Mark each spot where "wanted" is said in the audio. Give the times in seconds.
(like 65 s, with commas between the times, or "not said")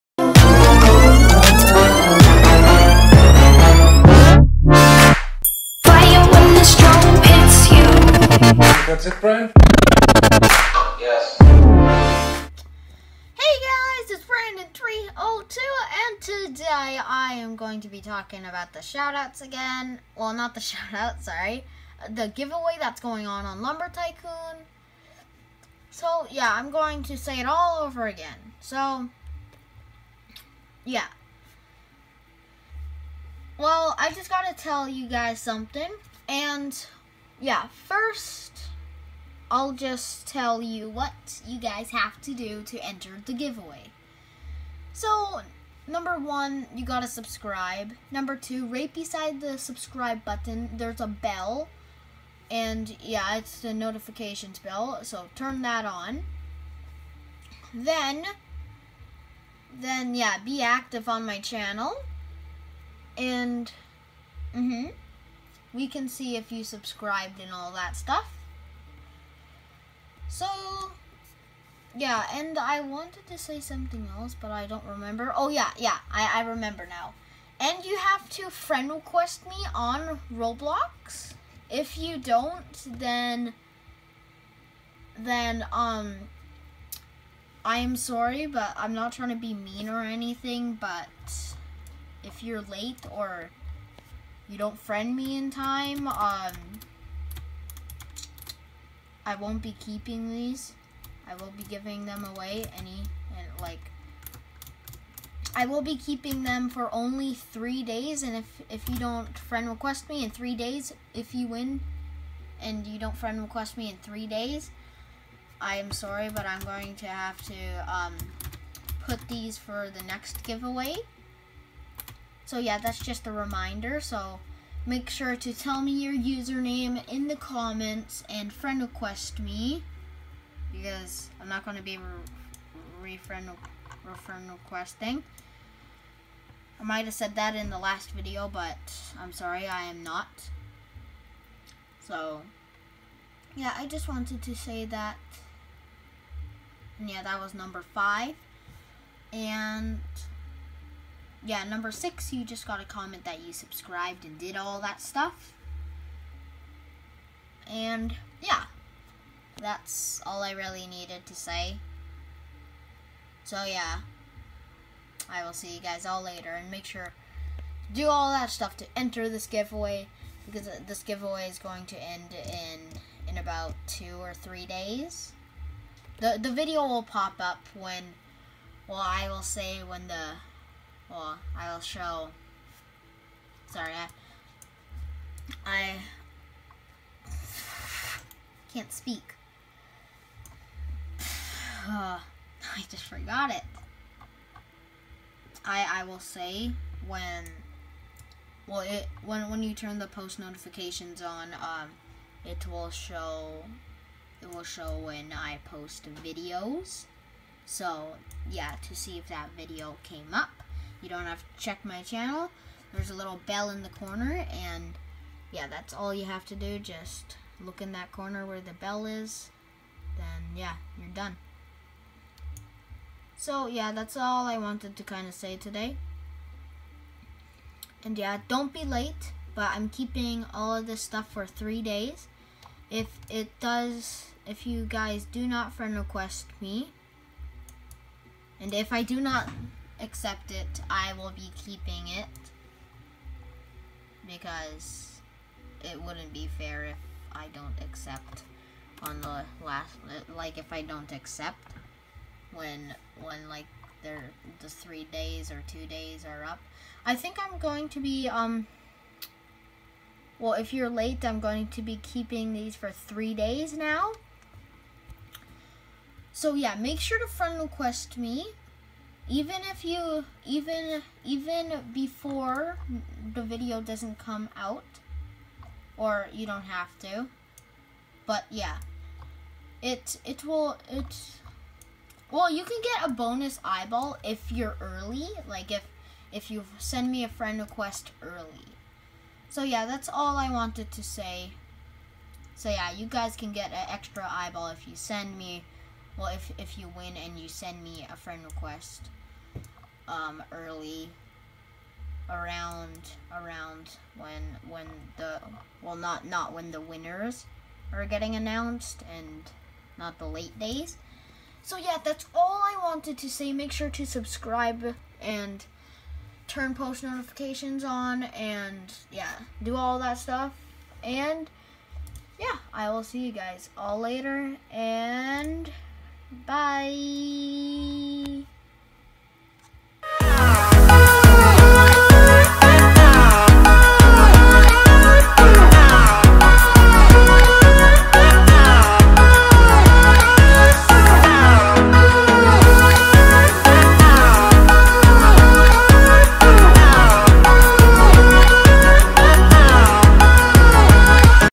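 72 s, 144 s, 224 s, 290 s, 312 s.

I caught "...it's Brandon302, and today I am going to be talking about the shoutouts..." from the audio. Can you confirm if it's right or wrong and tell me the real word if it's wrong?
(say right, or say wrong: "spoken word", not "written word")
right.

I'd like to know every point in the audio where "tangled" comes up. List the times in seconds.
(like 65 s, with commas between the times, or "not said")
not said.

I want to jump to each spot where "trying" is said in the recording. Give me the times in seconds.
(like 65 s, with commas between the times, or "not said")
89 s.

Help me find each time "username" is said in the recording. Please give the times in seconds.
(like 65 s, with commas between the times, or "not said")
126 s.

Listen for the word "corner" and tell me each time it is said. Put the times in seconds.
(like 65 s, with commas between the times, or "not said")
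213 s, 218 s.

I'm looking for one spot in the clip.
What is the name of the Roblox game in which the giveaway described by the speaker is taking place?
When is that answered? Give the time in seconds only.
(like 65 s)
23 s.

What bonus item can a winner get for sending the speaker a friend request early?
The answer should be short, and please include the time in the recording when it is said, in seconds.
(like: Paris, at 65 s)
an extra eyeball, at 283 s.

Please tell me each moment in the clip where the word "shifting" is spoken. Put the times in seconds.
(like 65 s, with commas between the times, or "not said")
not said.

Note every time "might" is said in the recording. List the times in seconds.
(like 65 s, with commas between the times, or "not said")
136 s.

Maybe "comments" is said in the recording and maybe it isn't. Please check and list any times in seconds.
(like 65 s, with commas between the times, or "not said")
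127 s, 152 s.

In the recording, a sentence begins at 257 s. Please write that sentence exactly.
I think I'm going to be, um, well, if you're late, I'm going to be keeping these for three days now.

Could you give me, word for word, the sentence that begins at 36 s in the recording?
And, yeah, first, I'll just tell you what you guys have to do to enter the giveaway.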